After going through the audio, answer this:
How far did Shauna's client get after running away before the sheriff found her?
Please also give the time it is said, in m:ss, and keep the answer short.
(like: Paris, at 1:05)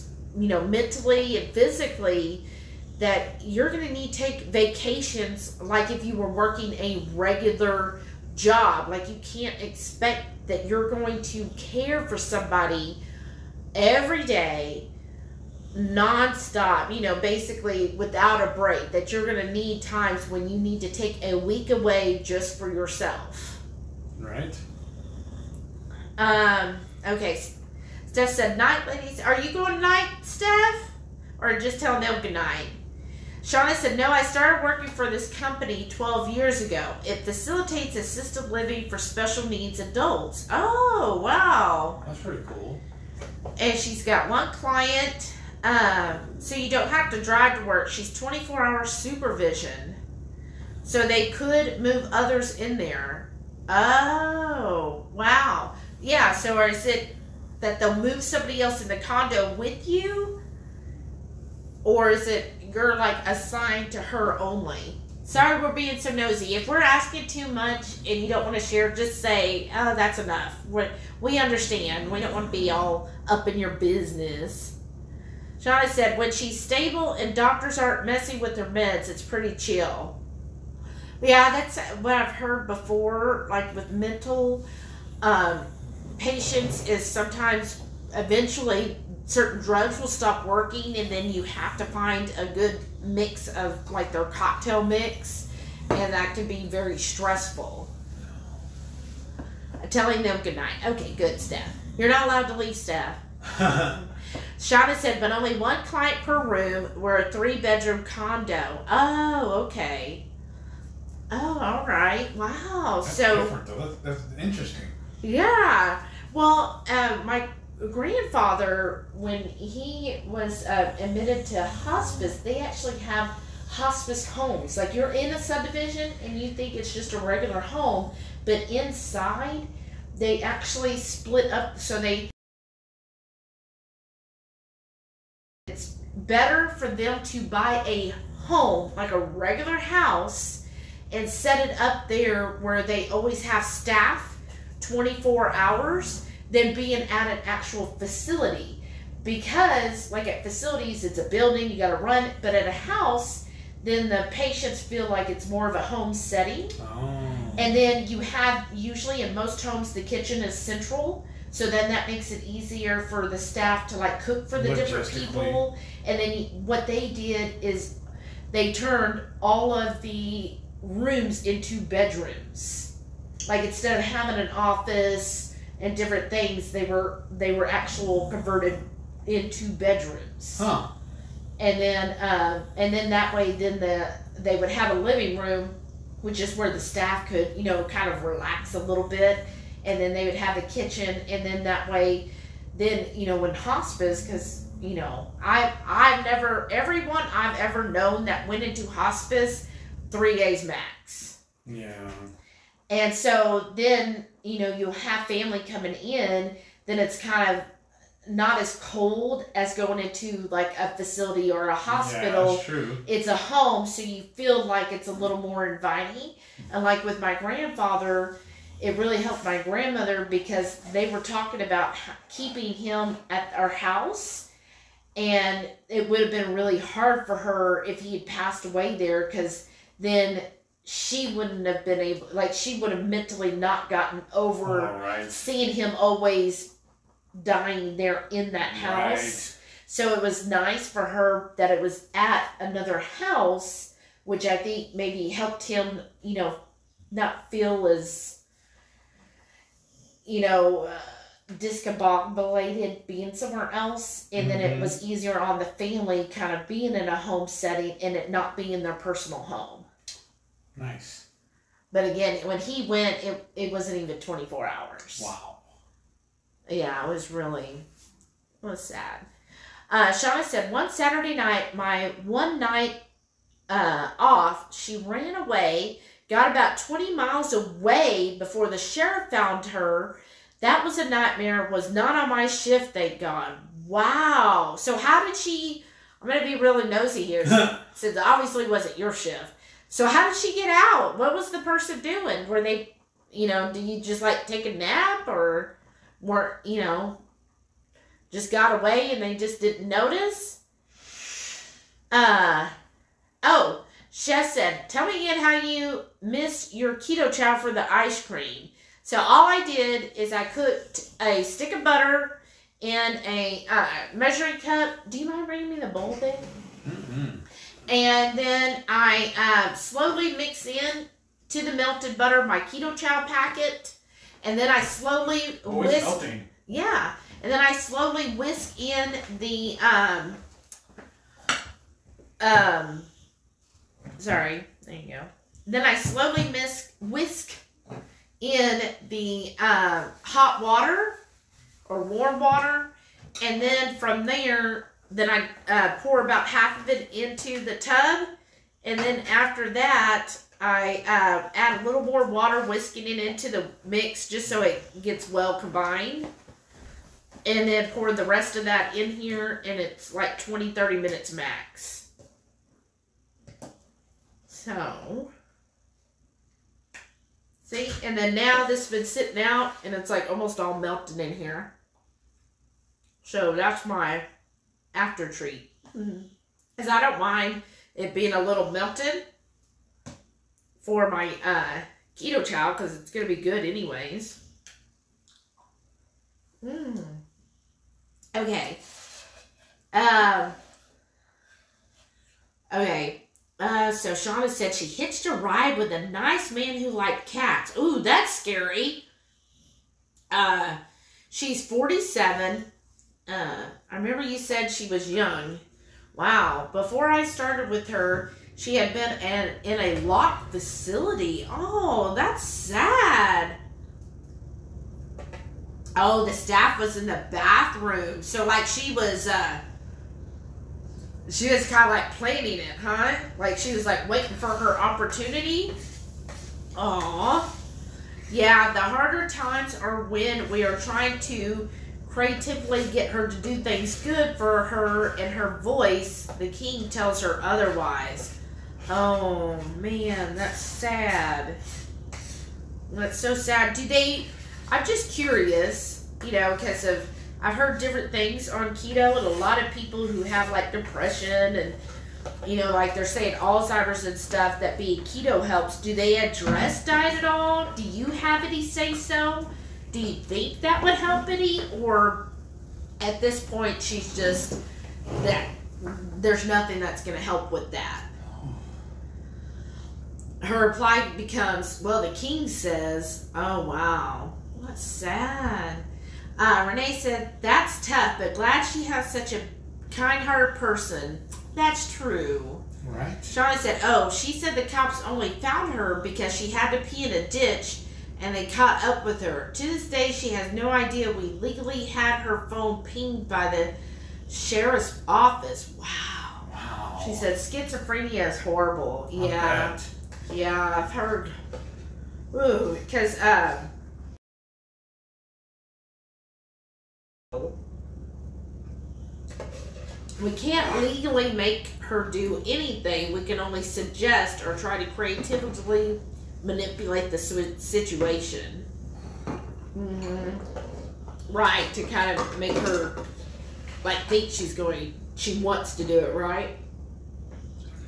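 20 miles, at 4:36.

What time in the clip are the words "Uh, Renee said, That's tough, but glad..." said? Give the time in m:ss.
7:56.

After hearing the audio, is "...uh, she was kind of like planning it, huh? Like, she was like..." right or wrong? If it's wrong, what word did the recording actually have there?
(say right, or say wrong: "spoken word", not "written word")
right.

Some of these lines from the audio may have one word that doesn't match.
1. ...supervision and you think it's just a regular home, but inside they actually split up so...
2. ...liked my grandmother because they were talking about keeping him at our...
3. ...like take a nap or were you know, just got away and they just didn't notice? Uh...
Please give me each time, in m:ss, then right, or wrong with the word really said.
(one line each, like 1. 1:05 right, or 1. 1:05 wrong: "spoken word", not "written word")
1. 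2:05 wrong: "subdivision", not "supervision"
2. 3:39 wrong: "helped", not "liked"
3. 4:54 right.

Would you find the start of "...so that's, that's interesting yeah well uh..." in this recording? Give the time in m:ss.
1:53.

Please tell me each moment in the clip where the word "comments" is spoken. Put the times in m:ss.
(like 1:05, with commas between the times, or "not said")
not said.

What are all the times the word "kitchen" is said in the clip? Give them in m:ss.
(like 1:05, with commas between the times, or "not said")
2:40, 3:10.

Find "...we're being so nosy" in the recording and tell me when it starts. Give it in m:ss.
1:05.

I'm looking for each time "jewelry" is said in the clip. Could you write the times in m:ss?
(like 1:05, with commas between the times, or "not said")
not said.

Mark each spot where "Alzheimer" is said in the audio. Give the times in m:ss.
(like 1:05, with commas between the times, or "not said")
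7:33.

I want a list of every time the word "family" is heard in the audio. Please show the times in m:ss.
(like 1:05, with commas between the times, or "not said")
3:25, 4:15.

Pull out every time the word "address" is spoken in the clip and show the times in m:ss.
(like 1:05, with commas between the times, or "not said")
7:36.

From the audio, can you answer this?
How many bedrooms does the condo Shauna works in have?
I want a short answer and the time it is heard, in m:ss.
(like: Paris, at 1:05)
3, at 1:47.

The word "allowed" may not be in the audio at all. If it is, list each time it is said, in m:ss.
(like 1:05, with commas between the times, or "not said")
1:42.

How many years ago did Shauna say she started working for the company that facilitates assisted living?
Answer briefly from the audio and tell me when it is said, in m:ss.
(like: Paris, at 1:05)
12, at 0:35.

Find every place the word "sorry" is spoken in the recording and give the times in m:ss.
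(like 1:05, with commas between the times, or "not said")
1:05, 5:34.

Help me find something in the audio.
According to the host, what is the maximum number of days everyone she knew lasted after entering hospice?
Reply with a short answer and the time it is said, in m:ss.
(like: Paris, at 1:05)
3 days, at 3:20.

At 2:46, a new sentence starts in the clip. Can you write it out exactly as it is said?
And then what they did is they turned all of the rooms into bedrooms.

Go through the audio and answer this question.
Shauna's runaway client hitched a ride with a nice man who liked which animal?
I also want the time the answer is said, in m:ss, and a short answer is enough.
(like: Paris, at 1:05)
cats, at 6:37.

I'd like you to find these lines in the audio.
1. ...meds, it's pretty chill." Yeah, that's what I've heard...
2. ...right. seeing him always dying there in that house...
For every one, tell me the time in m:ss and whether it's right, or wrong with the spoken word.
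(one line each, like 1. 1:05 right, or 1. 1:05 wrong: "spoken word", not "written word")
1. 1:18 right
2. 3:54 right.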